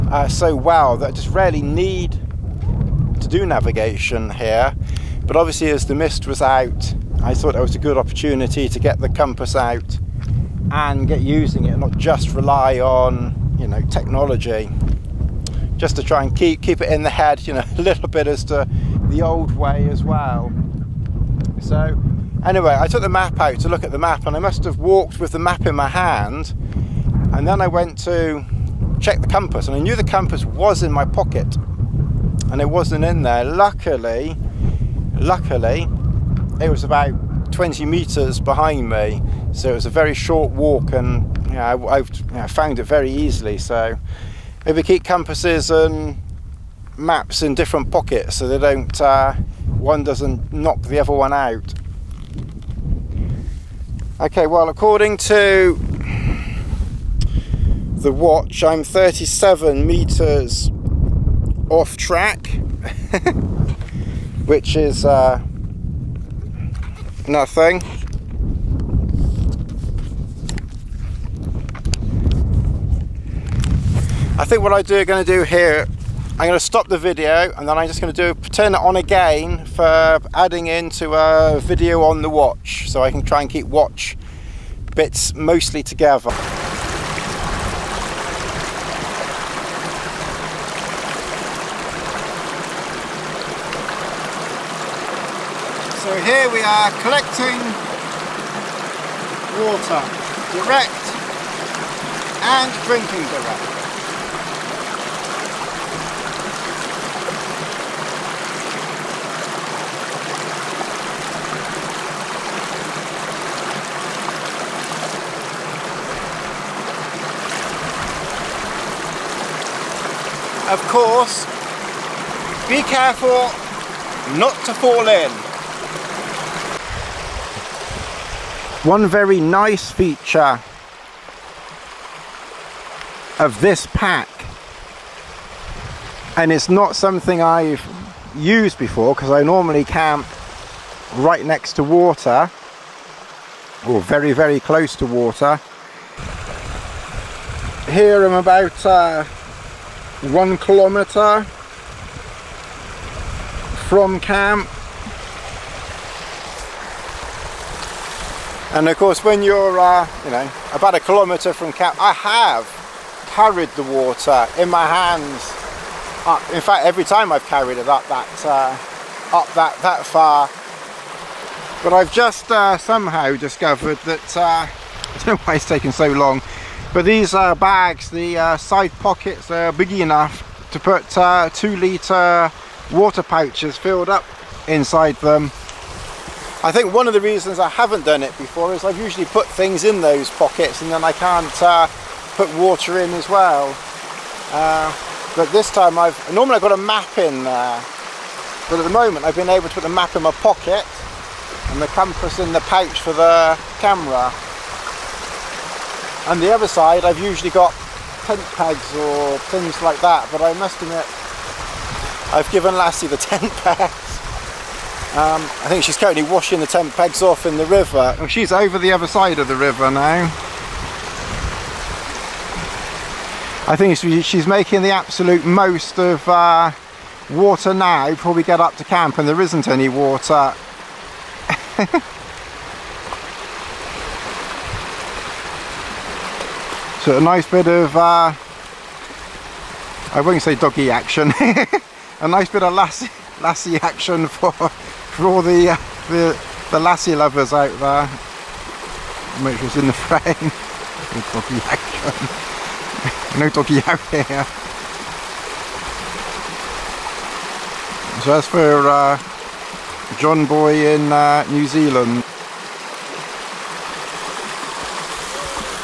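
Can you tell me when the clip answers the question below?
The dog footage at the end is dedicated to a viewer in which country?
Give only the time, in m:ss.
4:21.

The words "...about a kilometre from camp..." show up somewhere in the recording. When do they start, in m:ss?
2:40.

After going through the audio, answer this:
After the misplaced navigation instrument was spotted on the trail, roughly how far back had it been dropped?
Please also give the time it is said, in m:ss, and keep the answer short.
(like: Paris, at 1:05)
20 meters, at 0:37.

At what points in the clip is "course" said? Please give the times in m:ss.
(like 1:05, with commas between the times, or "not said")
2:00, 2:38.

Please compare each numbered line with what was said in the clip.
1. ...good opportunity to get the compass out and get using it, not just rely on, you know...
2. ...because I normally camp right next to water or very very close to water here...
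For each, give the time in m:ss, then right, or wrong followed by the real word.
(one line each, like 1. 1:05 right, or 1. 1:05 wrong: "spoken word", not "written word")
1. 0:07 right
2. 2:19 right.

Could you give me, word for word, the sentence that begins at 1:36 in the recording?
So here we are collecting water, direct and drinking direct.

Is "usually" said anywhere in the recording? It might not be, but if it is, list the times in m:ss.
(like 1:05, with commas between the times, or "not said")
3:08, 3:27.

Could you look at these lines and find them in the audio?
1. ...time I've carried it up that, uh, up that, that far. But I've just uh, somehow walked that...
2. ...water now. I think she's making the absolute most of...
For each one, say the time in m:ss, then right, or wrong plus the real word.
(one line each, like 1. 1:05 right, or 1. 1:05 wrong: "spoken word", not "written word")
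1. 2:47 wrong: "discovered", not "walked"
2. 3:39 wrong: "river", not "water".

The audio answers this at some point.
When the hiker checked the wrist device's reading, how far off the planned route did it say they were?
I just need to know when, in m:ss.
0:58.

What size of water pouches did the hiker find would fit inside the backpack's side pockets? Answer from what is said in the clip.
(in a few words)
2 litre.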